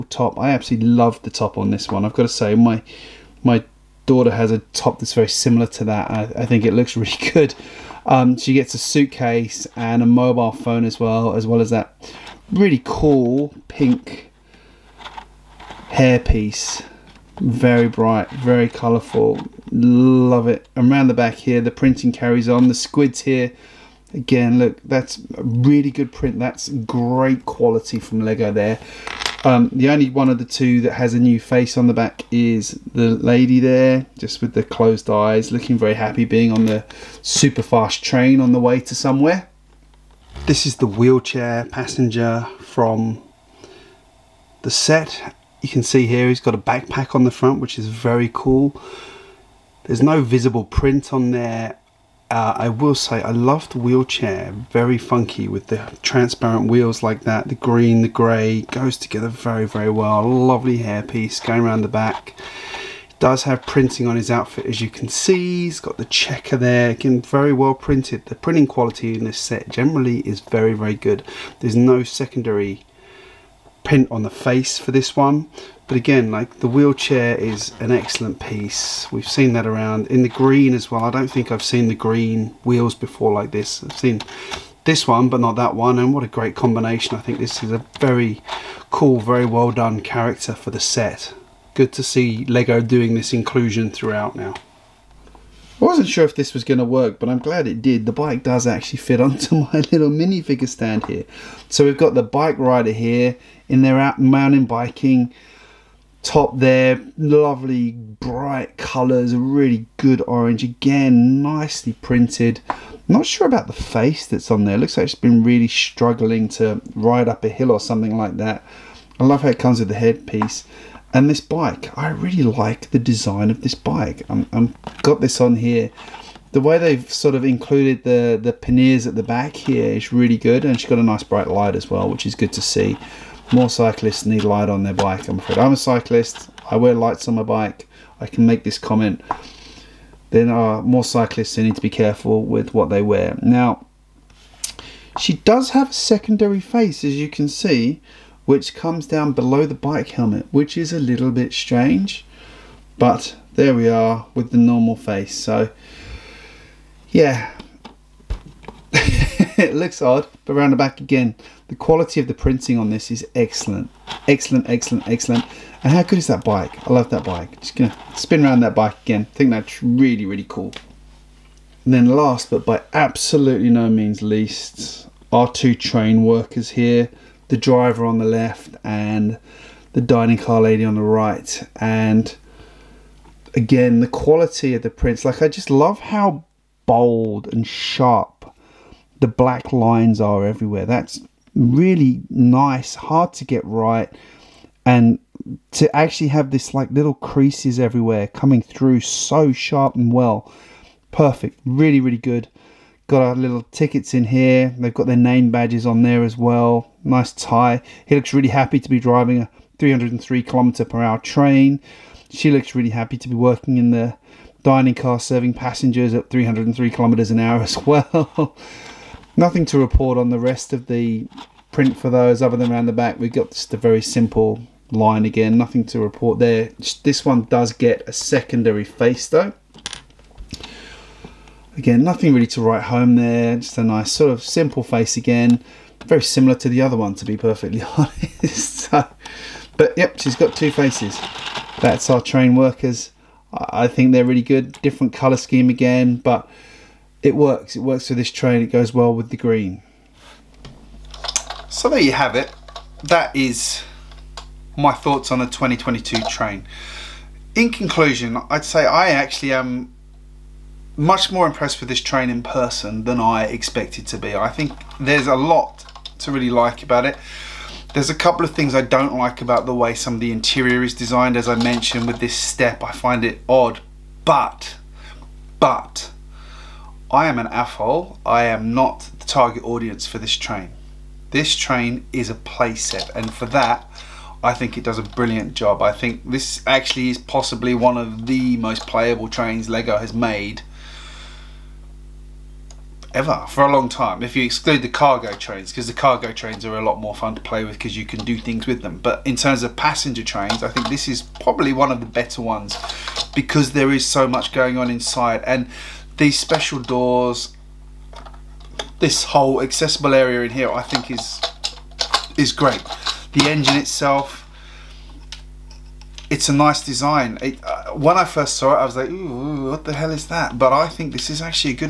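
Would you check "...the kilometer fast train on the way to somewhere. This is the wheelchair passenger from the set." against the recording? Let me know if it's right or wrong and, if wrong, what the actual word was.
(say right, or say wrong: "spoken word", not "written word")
wrong: "super", not "kilometer".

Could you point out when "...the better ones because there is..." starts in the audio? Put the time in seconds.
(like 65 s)
301 s.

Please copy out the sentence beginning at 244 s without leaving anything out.
Different colour scheme again, but it works.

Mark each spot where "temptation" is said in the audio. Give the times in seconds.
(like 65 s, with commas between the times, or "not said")
not said.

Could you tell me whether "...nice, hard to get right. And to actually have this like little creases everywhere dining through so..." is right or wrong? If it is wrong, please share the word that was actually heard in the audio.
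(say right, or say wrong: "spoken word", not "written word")
wrong: "coming", not "dining".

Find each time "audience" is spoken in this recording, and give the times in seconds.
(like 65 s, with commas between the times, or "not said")
279 s.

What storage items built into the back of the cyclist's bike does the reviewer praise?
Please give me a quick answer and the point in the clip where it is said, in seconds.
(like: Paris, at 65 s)
panniers, at 128 s.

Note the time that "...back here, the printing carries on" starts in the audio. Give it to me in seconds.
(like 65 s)
21 s.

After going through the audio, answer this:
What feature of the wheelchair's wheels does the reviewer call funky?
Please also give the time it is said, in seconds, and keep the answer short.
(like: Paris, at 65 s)
transparent, at 56 s.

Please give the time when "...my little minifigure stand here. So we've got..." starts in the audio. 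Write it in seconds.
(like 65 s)
99 s.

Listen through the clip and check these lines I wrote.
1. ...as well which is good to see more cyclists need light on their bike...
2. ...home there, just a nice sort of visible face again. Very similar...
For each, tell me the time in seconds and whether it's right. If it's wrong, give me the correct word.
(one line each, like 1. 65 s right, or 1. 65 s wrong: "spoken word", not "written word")
1. 131 s right
2. 232 s wrong: "simple", not "visible".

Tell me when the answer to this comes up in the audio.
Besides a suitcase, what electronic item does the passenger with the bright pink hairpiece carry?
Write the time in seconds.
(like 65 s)
10 s.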